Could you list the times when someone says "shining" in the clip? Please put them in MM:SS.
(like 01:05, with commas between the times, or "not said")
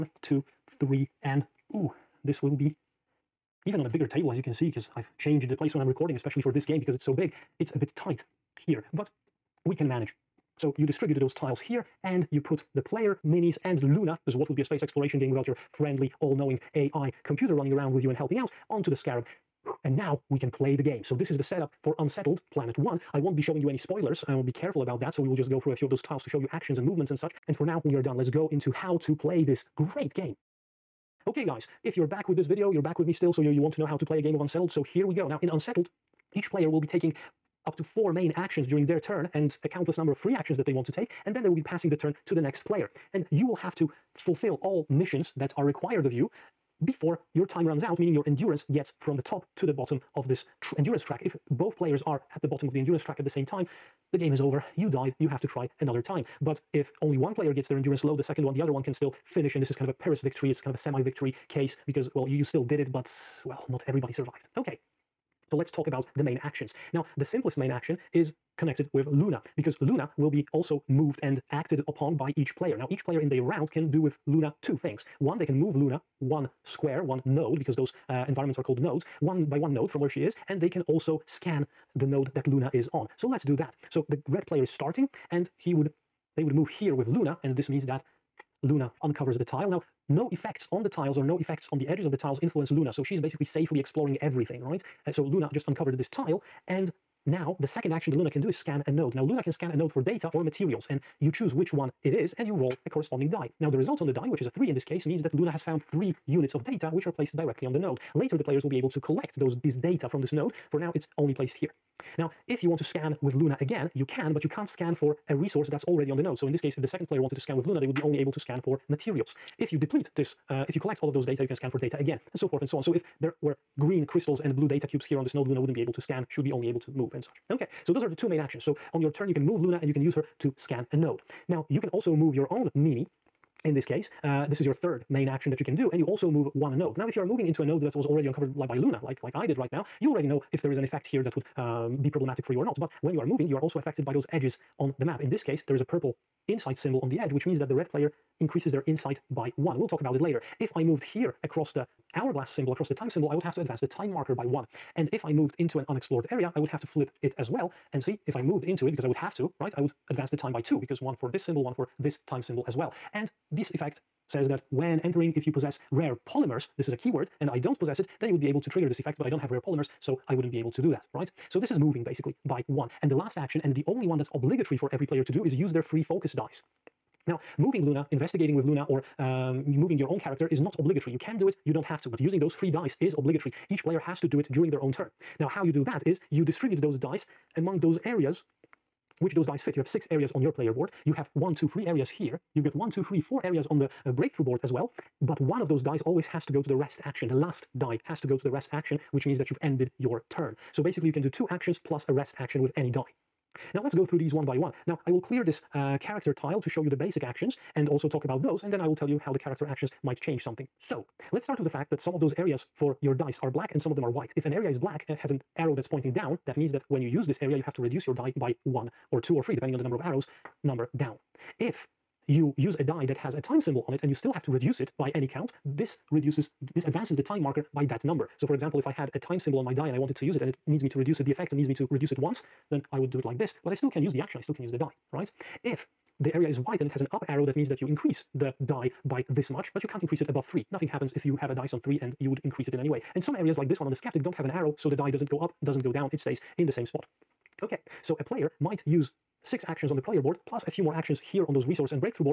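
not said.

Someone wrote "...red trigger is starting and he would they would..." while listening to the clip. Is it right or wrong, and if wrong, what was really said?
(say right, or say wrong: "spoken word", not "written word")
wrong: "player", not "trigger".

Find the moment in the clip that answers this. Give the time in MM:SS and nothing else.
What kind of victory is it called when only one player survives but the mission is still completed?
01:00.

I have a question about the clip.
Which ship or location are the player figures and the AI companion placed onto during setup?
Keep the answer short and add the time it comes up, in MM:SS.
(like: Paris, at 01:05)
the Scarab, at 00:18.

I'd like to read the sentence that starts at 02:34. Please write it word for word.
And if I moved into an unexplored area, I would have to flip it as well.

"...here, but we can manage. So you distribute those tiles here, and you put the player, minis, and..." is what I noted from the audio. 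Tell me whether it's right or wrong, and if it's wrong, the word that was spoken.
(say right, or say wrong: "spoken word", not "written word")
right.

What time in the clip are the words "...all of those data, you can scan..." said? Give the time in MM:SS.
02:01.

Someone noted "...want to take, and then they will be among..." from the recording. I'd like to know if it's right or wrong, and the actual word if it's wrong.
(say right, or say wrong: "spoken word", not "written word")
wrong: "passing", not "among".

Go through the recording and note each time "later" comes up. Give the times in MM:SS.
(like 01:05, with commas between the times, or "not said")
01:48, 02:30.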